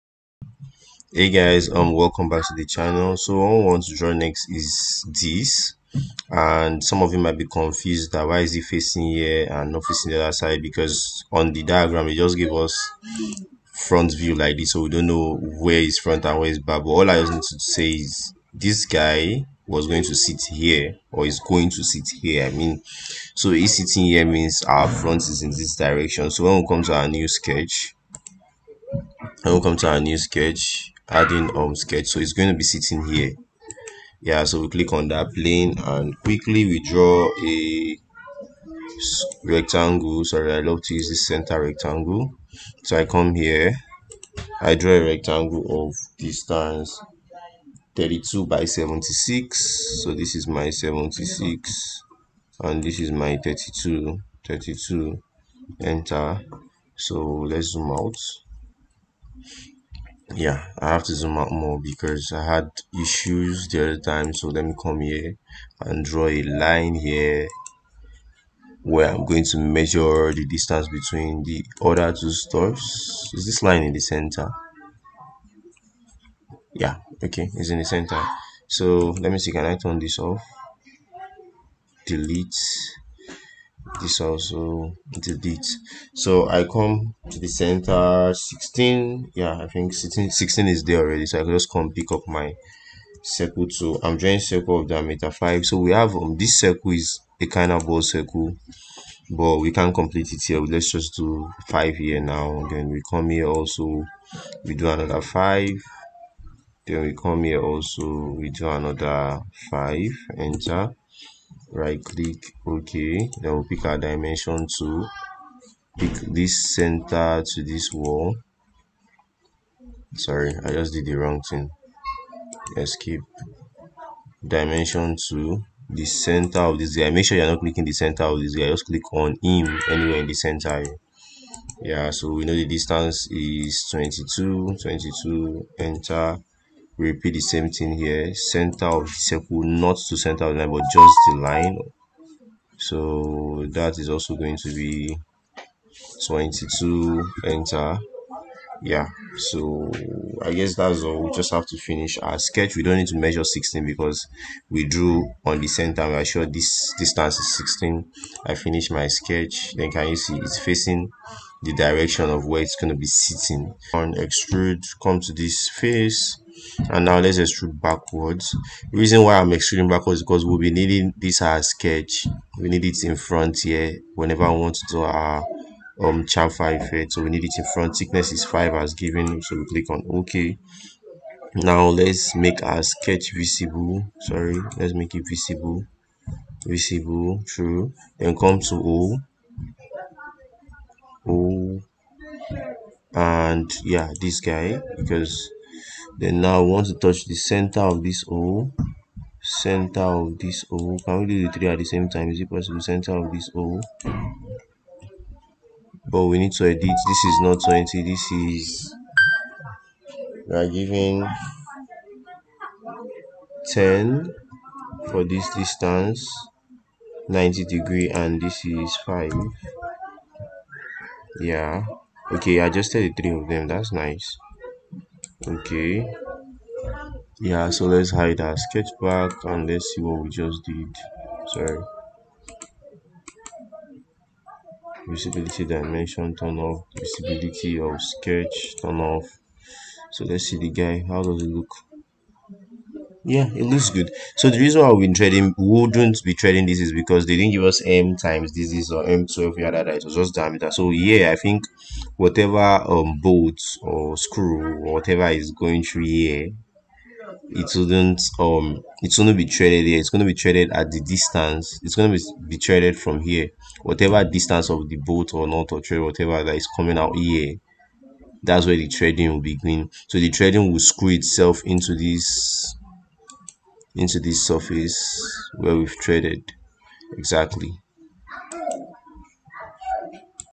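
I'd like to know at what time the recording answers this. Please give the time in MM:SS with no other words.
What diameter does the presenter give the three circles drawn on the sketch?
01:34.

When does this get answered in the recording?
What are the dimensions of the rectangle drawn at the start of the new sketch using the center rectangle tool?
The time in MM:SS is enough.
00:47.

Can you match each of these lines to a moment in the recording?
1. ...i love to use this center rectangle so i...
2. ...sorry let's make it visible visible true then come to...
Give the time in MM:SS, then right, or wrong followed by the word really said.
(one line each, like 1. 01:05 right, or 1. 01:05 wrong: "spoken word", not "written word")
1. 00:40 right
2. 03:04 right.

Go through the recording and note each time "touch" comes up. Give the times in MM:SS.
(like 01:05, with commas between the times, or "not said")
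03:16.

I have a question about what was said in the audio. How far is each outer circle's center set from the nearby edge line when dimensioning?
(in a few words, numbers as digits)
22.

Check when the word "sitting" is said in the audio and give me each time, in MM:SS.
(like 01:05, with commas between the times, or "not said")
00:23, 00:32, 02:43.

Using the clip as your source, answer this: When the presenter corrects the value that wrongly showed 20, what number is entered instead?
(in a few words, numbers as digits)
10.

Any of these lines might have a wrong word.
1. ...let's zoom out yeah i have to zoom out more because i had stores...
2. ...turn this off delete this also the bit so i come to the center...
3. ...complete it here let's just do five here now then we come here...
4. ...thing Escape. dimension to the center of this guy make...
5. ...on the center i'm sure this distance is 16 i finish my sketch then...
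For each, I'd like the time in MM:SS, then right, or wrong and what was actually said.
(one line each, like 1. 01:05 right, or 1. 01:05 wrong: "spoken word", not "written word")
1. 00:57 wrong: "issues", not "stores"
2. 01:19 right
3. 01:39 right
4. 02:01 right
5. 02:35 right.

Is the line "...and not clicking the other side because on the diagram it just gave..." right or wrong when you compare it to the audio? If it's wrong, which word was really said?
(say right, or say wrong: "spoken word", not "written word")
wrong: "facing", not "clicking".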